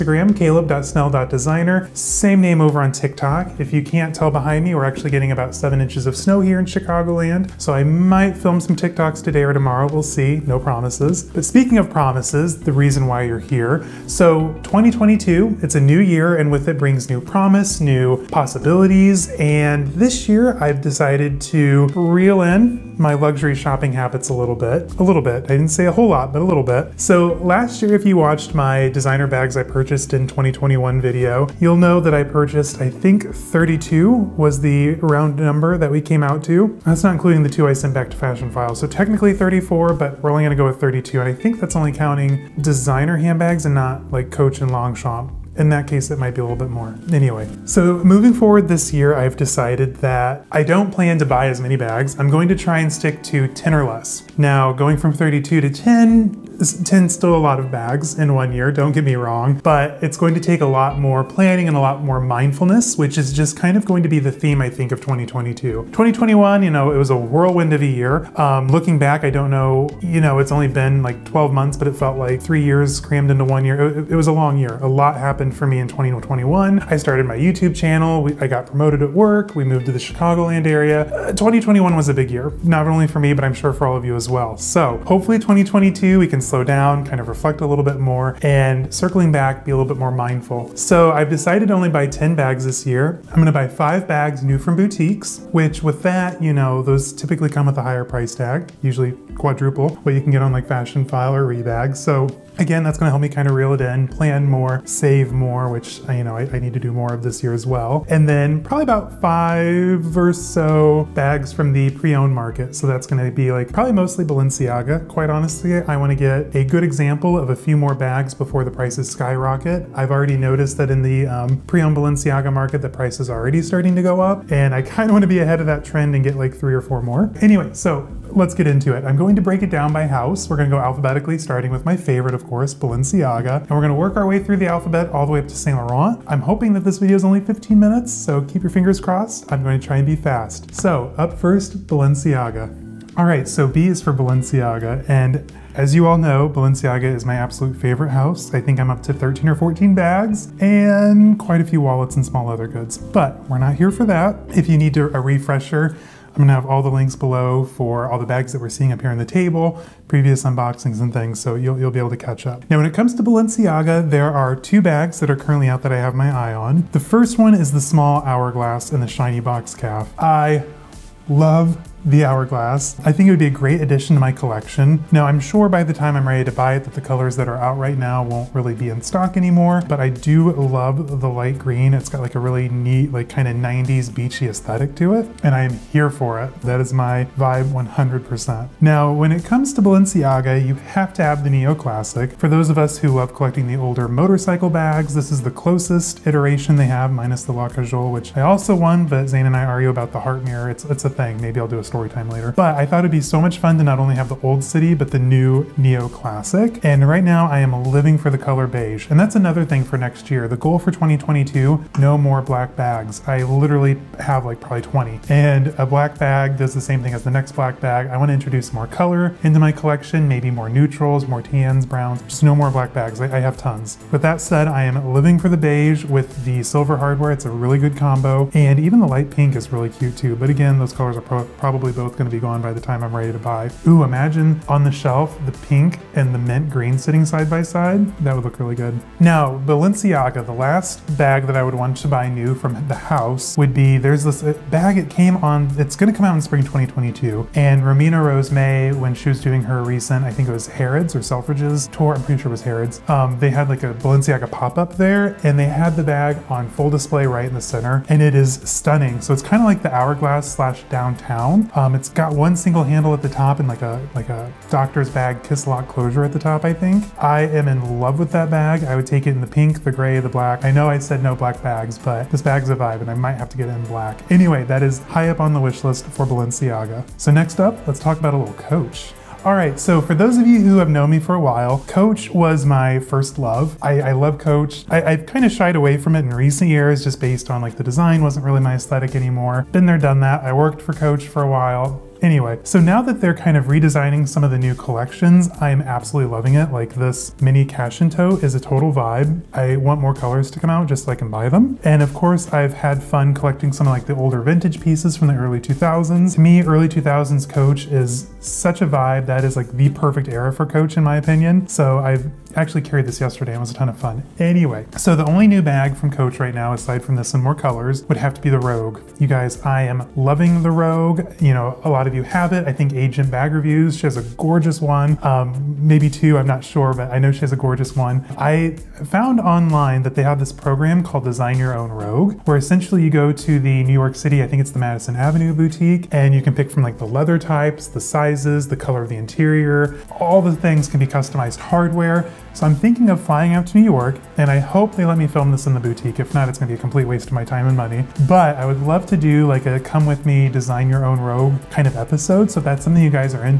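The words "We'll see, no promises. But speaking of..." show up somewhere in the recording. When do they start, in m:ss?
0:09.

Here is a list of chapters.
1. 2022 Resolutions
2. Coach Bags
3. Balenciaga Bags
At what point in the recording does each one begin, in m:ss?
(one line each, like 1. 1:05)
1. 0:10
2. 4:38
3. 2:22.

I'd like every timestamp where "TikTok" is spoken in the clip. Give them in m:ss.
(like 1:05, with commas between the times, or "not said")
0:02, 0:08.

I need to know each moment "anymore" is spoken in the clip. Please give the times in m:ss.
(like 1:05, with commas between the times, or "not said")
2:59, 4:49.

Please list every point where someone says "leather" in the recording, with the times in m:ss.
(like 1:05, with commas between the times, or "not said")
2:32, 5:37.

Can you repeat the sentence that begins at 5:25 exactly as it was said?
Um, maybe two, I'm not sure, but I know she has a gorgeous one.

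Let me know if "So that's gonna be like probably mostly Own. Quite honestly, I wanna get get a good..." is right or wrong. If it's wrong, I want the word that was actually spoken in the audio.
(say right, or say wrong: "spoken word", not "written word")
wrong: "Balenciaga", not "Own".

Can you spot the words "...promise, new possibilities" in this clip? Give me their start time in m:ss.
0:17.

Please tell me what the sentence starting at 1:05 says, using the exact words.
2021, you know, it was a whirlwind of a year.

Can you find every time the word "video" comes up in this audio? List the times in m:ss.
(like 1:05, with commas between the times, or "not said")
0:30, 2:16.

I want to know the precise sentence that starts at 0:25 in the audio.
I didn't say a whole lot, but a little bit.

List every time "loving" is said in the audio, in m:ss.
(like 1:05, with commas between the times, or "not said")
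4:56, 5:20.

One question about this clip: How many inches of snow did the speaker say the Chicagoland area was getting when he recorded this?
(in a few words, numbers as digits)
7.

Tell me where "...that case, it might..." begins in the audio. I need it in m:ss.
0:45.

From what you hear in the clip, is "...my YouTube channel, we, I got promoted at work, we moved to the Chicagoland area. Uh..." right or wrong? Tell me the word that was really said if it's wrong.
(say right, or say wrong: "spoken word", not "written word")
right.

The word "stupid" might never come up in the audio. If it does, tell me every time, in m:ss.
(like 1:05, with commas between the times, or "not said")
not said.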